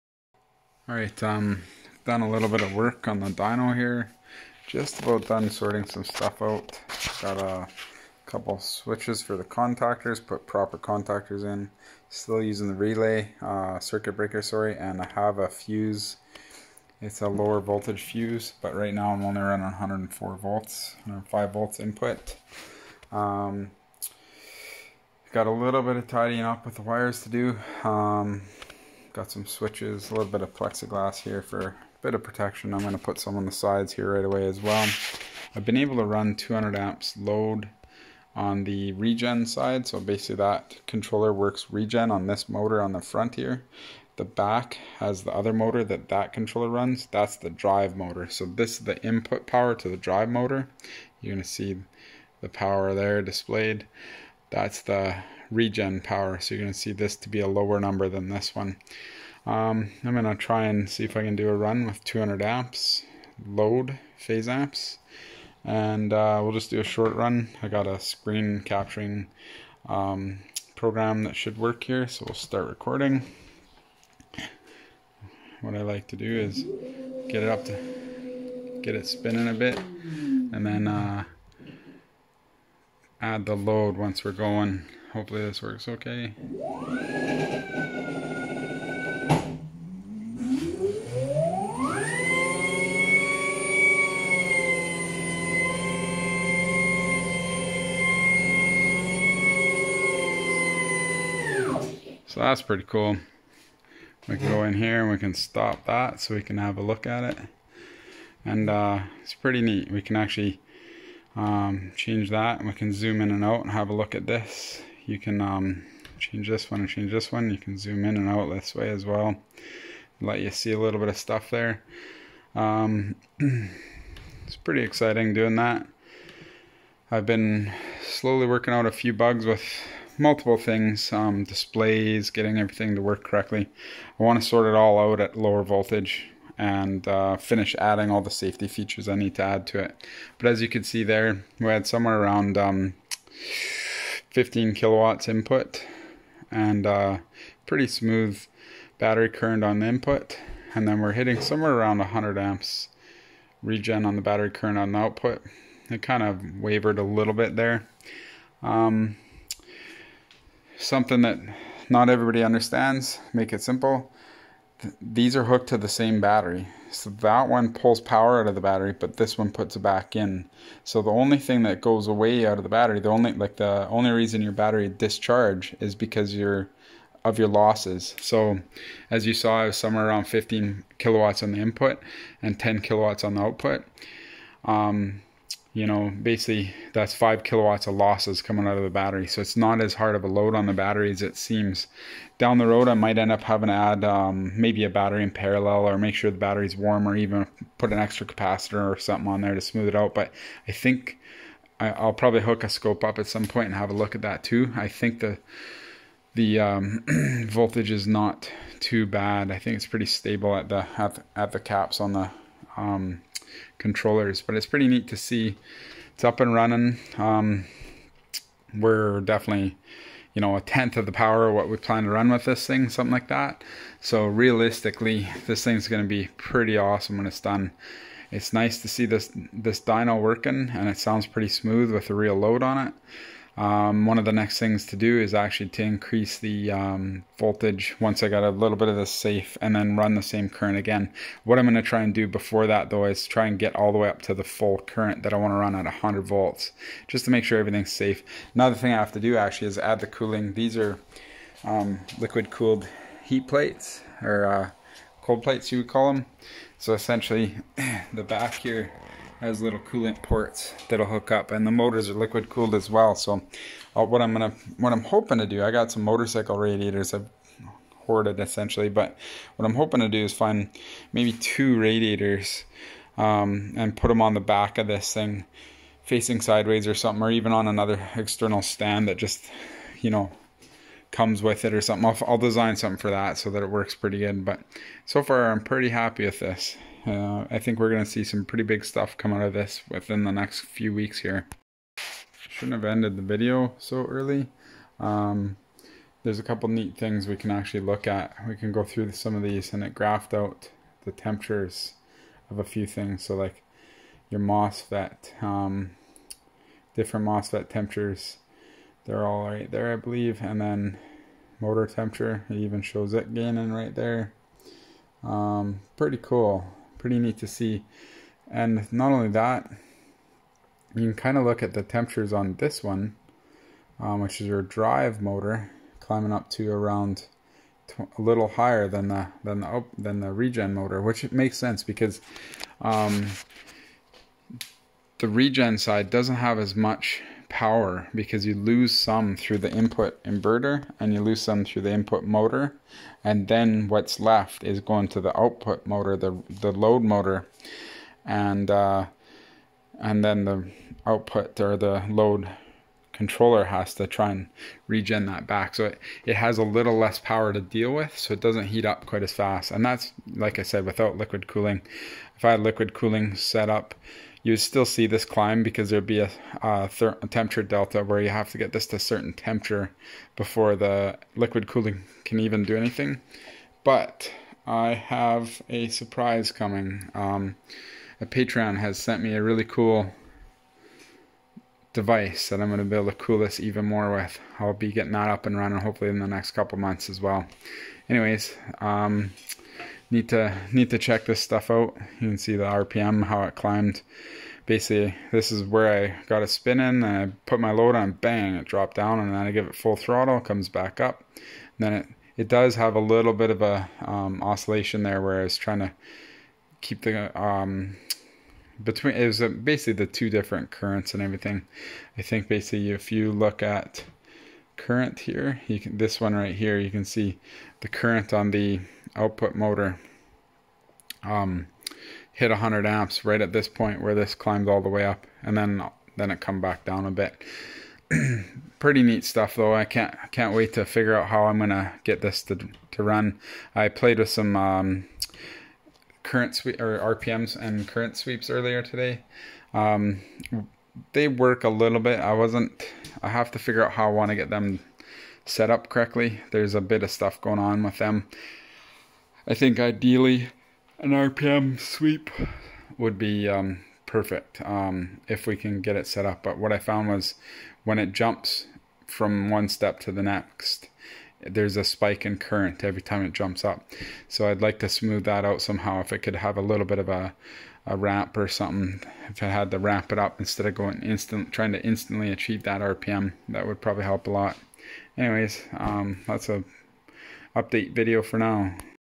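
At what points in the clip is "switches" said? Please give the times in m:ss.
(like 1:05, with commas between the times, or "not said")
0:08, 0:29.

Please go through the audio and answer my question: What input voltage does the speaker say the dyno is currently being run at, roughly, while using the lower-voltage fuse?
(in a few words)
104 volts.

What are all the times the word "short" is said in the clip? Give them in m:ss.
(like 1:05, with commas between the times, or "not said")
1:06.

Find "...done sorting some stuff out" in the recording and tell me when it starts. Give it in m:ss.
0:05.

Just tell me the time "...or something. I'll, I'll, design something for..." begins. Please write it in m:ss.
4:41.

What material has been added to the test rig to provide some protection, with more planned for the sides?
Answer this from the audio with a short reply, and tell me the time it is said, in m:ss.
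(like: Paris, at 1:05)
plexiglass, at 0:30.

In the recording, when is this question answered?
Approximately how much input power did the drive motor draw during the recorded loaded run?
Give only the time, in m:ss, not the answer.
2:24.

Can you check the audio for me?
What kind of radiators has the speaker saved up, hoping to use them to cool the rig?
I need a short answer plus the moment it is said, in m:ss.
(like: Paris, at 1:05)
motorcycle radiators, at 4:26.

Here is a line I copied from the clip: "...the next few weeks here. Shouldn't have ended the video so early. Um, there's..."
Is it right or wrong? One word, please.
right.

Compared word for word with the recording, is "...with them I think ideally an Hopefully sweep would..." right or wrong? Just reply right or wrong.
wrong.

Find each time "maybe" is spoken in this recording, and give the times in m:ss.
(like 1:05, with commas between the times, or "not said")
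3:14, 4:31.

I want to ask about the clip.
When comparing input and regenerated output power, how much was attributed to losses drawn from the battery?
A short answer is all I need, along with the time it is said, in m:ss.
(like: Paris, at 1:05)
5 kilowatts, at 3:07.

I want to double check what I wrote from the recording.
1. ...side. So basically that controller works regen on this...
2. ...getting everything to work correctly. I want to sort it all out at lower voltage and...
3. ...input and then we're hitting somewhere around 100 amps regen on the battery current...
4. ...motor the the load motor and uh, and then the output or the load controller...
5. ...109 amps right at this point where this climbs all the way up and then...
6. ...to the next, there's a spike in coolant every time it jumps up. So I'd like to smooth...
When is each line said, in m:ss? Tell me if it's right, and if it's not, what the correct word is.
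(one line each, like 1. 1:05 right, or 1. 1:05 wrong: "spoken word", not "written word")
1. 0:39 right
2. 2:12 right
3. 2:29 right
4. 5:45 right
5. 7:02 wrong: "100", not "109"
6. 7:40 wrong: "current", not "coolant".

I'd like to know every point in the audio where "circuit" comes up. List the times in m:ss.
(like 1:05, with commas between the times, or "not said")
0:13.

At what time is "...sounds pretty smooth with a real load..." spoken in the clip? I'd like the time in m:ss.
3:50.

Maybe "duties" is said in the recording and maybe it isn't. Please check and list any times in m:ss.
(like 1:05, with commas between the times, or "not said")
not said.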